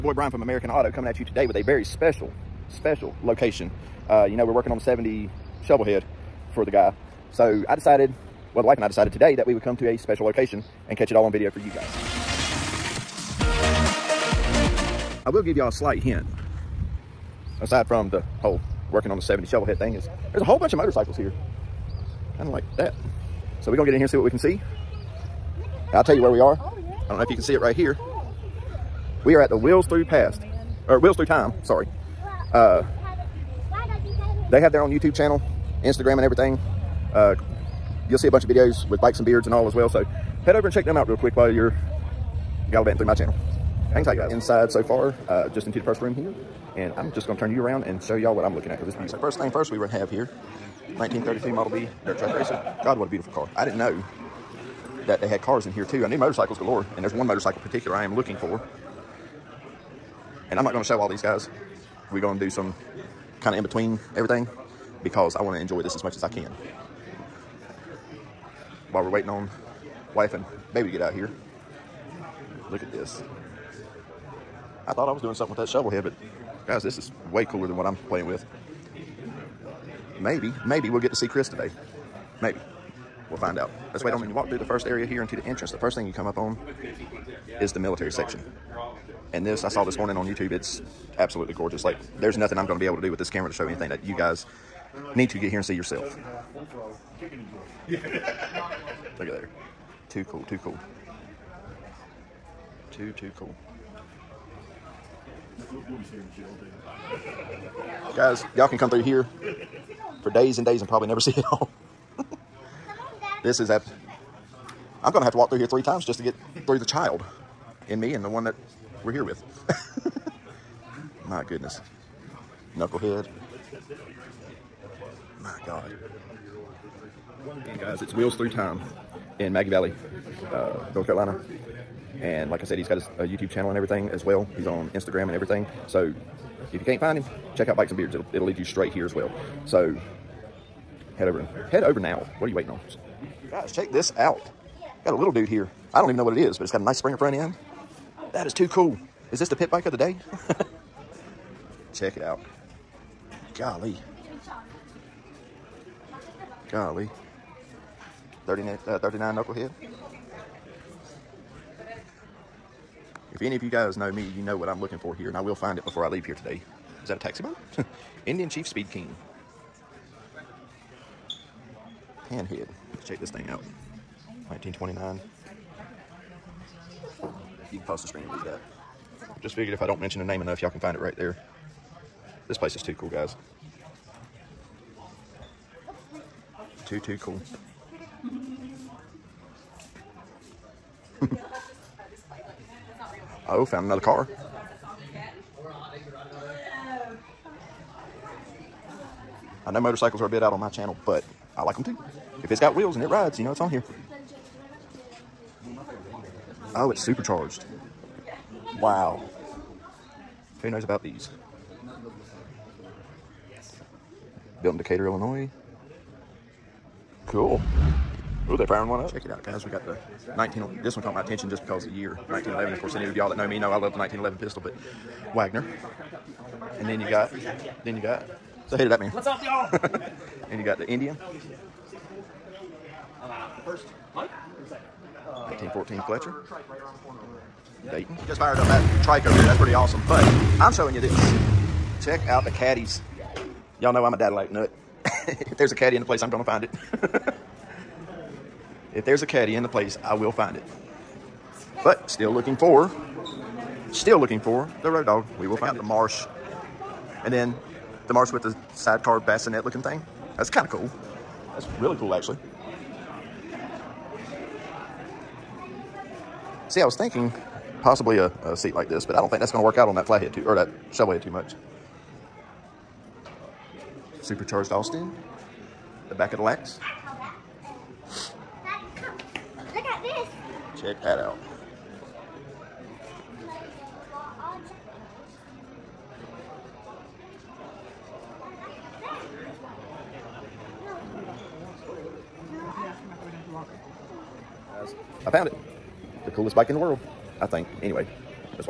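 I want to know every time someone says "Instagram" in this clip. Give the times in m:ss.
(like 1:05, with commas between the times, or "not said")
0:35, 2:14.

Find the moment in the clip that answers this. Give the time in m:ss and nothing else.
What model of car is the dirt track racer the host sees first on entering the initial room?
0:50.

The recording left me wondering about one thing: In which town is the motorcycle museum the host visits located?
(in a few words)
Maggie Valley.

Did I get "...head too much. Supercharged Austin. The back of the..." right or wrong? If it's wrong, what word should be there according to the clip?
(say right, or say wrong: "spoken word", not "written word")
right.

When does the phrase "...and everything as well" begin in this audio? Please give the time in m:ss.
2:13.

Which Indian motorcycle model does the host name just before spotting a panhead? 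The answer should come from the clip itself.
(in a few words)
Chief Speed King.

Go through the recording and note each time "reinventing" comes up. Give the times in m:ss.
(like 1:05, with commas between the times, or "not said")
not said.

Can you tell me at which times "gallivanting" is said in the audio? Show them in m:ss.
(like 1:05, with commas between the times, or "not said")
0:42.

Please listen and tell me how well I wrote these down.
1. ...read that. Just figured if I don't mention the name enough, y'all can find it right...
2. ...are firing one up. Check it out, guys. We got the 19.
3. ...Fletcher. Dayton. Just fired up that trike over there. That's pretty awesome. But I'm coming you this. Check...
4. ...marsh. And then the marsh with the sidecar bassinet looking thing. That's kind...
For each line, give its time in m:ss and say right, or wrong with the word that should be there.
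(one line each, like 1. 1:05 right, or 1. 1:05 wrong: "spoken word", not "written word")
1. 2:58 right
2. 3:38 right
3. 3:56 wrong: "showing", not "coming"
4. 4:15 right.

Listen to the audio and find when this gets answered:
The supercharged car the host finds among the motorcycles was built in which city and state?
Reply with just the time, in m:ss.
3:34.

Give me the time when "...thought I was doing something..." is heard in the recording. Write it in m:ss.
1:14.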